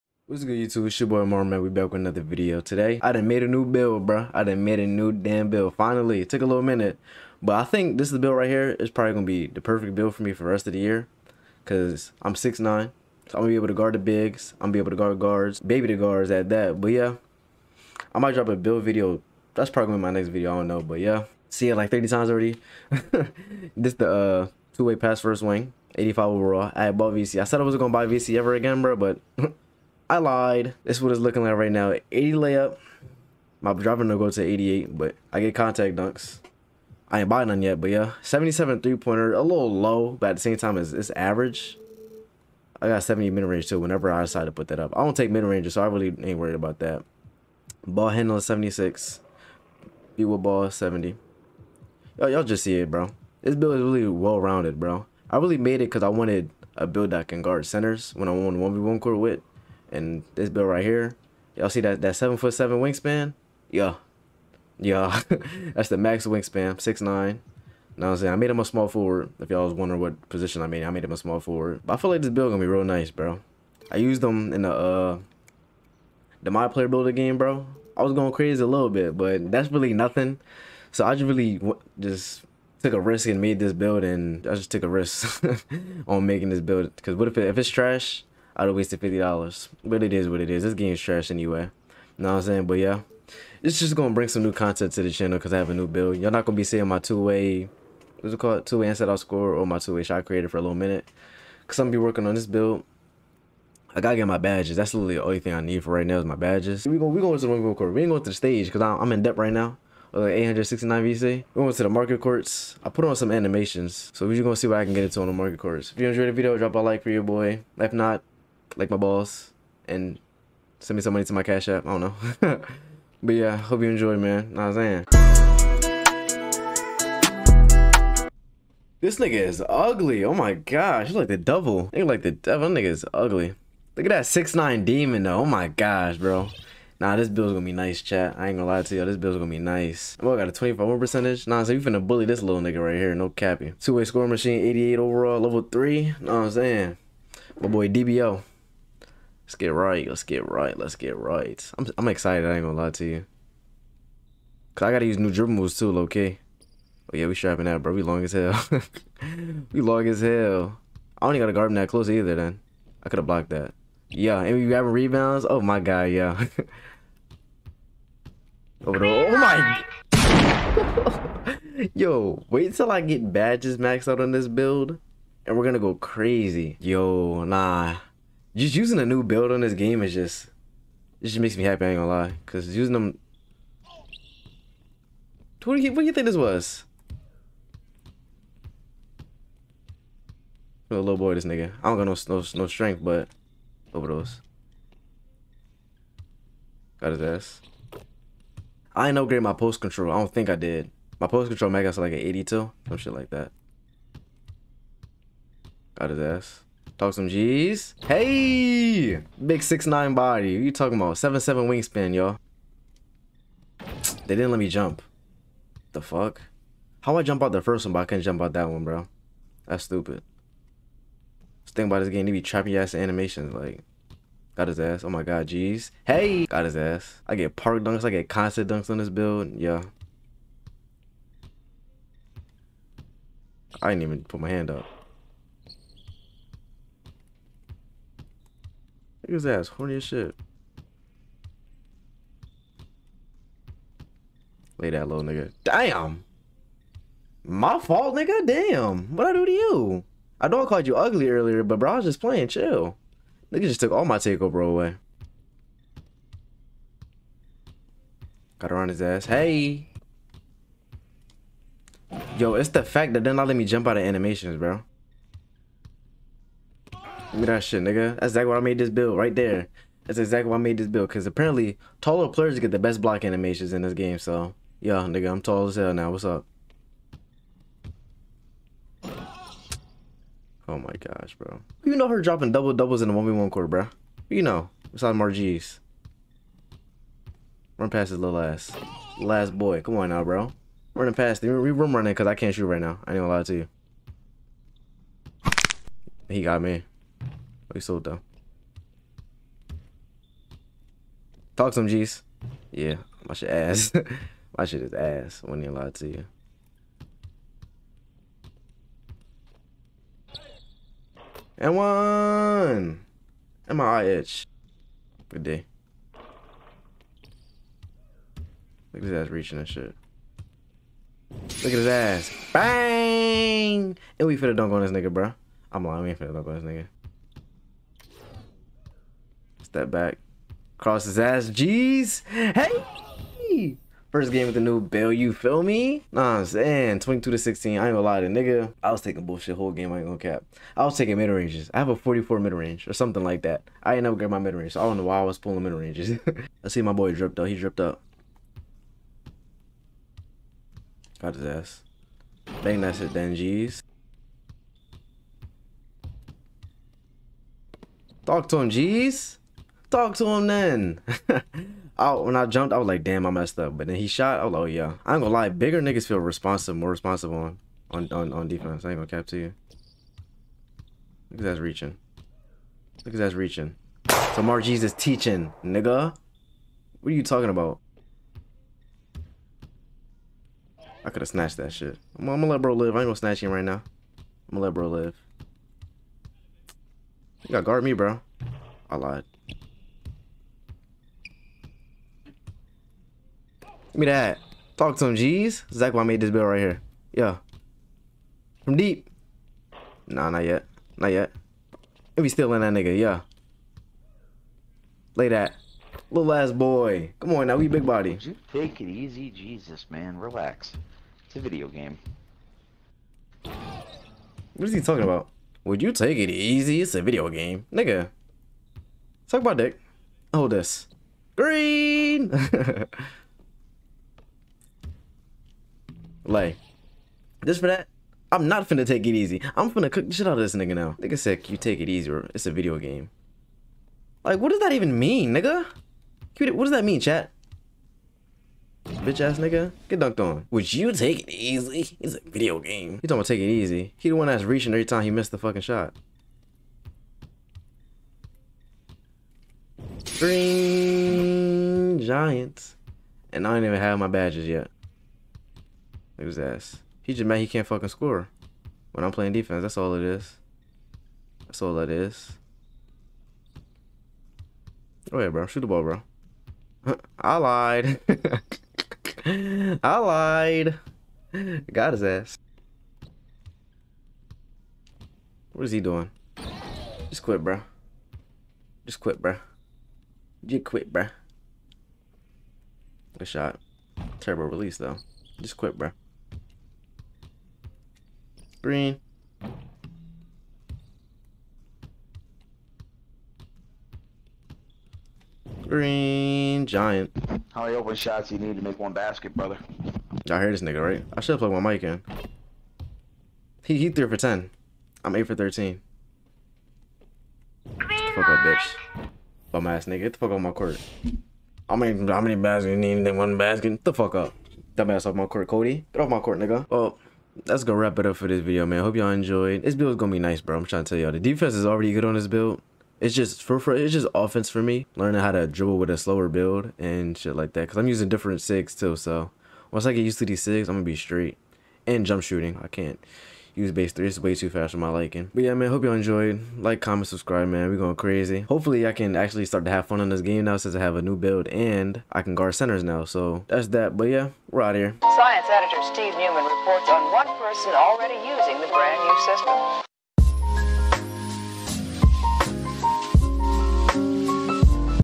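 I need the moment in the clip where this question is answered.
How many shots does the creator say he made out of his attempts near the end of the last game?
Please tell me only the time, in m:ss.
8:25.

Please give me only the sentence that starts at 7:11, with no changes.
Nigga said, you take it easier.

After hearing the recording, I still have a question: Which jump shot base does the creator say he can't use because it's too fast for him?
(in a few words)
Base 3.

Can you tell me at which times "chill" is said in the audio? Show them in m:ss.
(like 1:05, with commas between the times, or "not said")
4:12.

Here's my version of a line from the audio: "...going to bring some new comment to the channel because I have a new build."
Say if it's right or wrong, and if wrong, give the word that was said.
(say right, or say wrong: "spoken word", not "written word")
wrong: "content", not "comment".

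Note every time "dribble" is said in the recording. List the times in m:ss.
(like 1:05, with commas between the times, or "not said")
2:35, 8:45.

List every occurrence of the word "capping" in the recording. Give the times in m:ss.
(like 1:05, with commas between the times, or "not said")
2:23.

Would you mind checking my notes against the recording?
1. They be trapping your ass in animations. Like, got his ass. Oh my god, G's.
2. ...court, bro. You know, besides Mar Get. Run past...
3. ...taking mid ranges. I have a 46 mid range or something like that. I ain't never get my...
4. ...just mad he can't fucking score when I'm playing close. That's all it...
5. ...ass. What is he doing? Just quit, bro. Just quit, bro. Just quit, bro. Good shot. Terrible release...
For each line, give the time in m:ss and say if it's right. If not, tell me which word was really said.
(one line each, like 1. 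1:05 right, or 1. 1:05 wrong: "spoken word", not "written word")
1. 3:42 right
2. 4:43 wrong: "Geeez", not "Get"
3. 5:40 wrong: "44", not "46"
4. 7:37 wrong: "defense", not "close"
5. 7:52 right.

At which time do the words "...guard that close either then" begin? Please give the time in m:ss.
2:41.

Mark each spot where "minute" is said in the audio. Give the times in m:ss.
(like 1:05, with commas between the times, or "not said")
0:06, 1:40.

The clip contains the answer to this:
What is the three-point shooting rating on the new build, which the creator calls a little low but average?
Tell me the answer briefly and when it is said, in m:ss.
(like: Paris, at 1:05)
77, at 0:38.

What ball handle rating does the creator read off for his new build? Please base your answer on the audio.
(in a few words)
76.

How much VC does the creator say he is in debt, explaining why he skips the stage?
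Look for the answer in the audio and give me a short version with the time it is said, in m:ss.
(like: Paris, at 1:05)
869, at 1:50.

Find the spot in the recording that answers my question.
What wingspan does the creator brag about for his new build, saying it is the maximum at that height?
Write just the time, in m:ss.
1:02.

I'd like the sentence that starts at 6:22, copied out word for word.
I'm, I'm, gonna let bro live.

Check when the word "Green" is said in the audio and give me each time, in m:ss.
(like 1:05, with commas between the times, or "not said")
7:01, 7:30, 8:15, 8:27.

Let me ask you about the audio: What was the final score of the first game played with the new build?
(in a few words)
22 to 16.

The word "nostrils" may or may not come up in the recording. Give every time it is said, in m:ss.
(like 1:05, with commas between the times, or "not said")
not said.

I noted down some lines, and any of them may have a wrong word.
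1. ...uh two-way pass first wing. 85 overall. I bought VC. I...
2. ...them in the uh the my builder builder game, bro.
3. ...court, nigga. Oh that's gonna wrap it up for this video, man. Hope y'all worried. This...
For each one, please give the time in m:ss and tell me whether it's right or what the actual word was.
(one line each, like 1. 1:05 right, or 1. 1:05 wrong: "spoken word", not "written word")
1. 0:24 right
2. 1:14 wrong: "player", not "builder"
3. 8:36 wrong: "enjoyed", not "worried".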